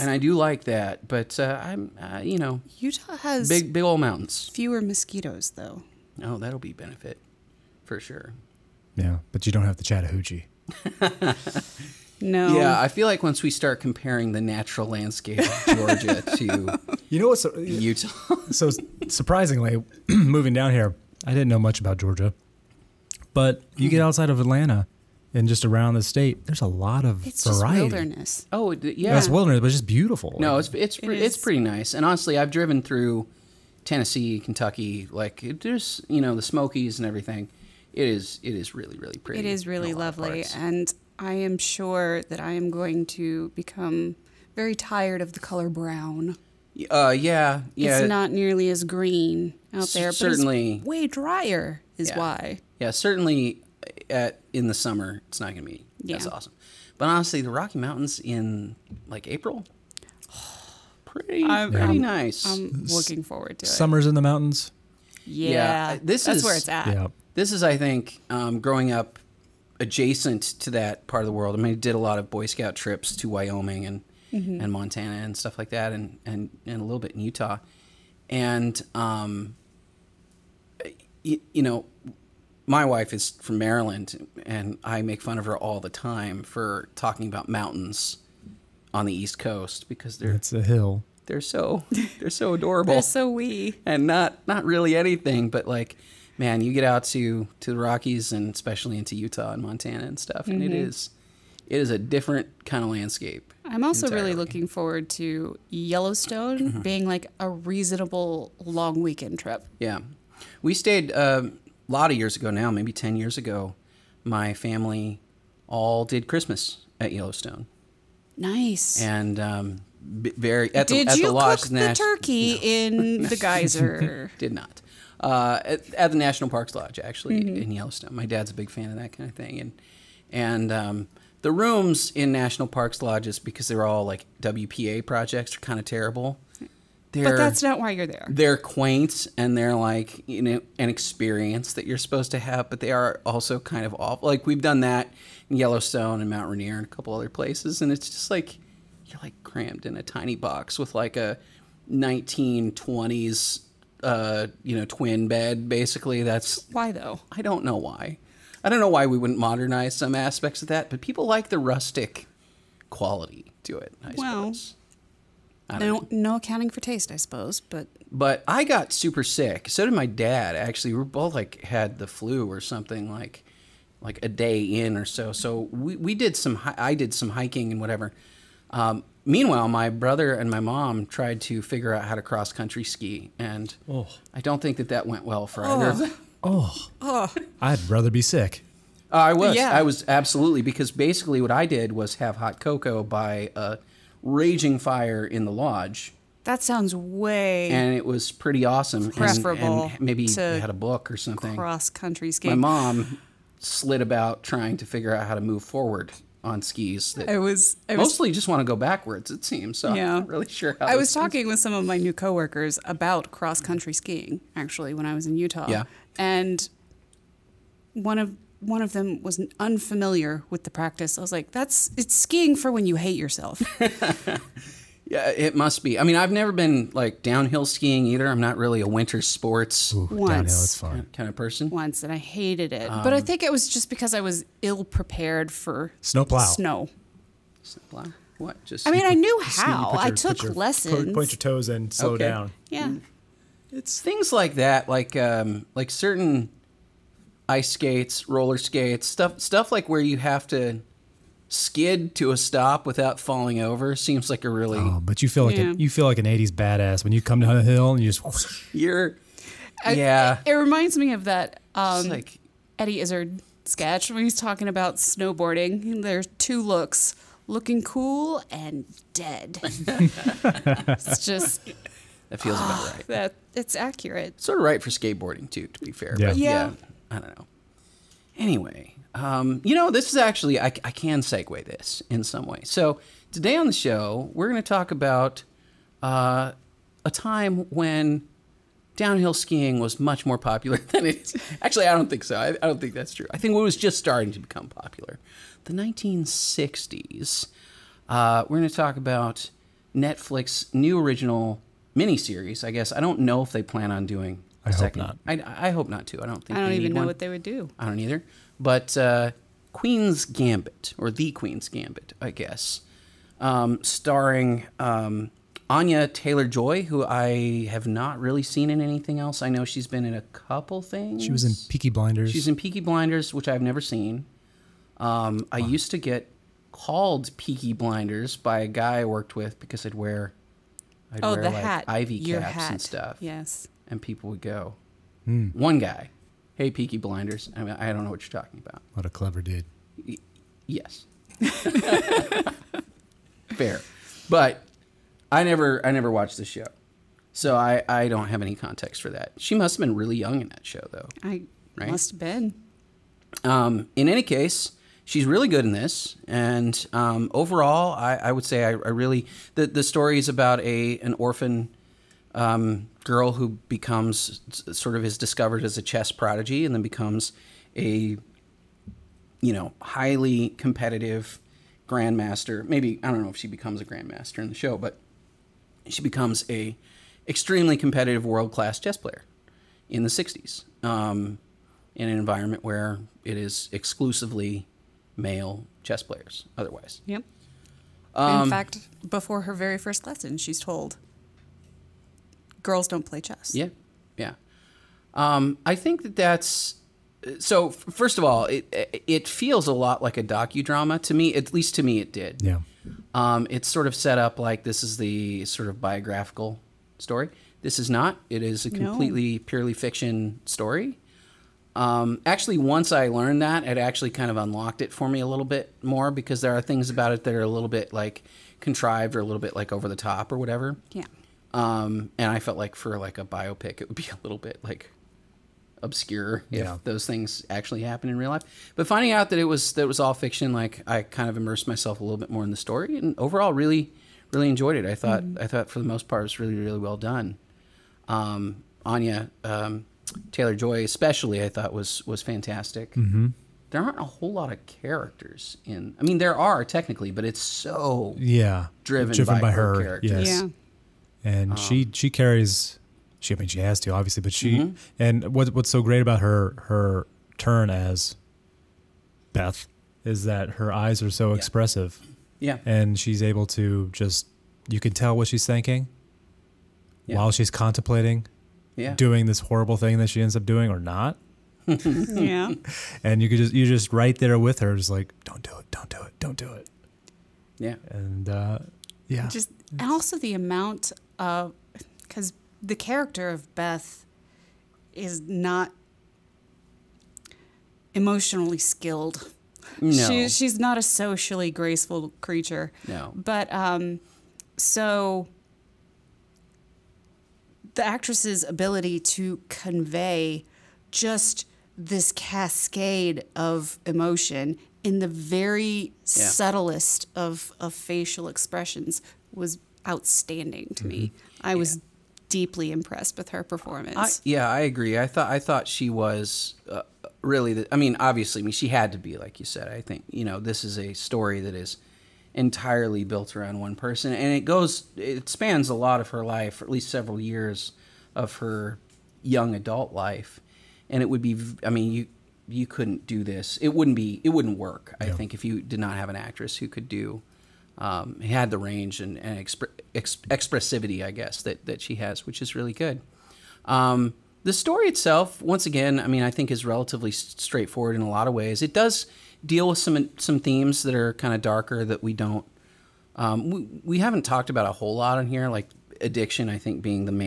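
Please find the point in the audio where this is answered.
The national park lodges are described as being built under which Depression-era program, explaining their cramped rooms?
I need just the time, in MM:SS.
02:14.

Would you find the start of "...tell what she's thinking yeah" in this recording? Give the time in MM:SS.
07:44.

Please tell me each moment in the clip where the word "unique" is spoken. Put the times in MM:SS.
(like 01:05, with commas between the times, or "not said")
not said.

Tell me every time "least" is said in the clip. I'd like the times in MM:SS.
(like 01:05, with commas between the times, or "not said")
06:41, 08:46.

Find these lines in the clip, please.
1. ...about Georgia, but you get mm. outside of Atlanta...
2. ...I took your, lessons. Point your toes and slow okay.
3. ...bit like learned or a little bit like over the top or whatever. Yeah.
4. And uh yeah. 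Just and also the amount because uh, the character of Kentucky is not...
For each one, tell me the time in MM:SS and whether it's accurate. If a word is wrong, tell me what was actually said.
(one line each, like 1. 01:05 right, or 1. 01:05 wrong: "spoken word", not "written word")
1. 00:21 right
2. 04:00 right
3. 06:57 wrong: "contrived", not "learned"
4. 07:57 wrong: "Beth", not "Kentucky".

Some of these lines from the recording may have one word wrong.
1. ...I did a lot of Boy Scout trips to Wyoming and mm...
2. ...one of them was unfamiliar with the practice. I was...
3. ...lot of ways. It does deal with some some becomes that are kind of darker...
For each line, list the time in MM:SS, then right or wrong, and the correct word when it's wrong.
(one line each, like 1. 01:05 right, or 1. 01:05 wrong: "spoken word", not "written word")
1. 01:11 right
2. 03:38 right
3. 09:08 wrong: "themes", not "becomes".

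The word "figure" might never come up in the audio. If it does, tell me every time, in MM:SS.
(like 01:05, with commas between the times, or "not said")
03:01, 03:24.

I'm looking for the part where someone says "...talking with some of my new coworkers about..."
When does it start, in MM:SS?
03:31.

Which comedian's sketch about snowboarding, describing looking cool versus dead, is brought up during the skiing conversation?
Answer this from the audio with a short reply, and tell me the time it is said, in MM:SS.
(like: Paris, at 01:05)
Eddie Izzard, at 04:22.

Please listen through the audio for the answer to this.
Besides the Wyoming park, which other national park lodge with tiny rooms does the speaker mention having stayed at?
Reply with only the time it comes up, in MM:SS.
02:26.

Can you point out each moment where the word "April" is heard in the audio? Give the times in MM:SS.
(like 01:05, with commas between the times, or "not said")
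00:59.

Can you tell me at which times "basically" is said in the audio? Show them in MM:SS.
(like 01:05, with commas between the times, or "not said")
02:35, 03:10.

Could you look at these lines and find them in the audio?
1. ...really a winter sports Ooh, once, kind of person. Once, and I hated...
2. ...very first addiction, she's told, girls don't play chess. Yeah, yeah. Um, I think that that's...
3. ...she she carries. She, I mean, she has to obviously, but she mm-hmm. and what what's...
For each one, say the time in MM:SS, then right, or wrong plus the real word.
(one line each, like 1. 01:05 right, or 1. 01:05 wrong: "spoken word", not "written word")
1. 03:48 right
2. 06:29 wrong: "lesson", not "addiction"
3. 07:31 right.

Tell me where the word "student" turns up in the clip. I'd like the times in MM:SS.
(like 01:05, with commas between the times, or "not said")
not said.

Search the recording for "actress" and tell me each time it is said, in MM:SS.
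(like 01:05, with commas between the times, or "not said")
08:17, 08:56.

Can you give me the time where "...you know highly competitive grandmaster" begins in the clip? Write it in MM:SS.
06:09.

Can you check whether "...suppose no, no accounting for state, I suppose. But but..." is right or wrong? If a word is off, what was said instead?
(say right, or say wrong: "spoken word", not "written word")
wrong: "taste", not "state".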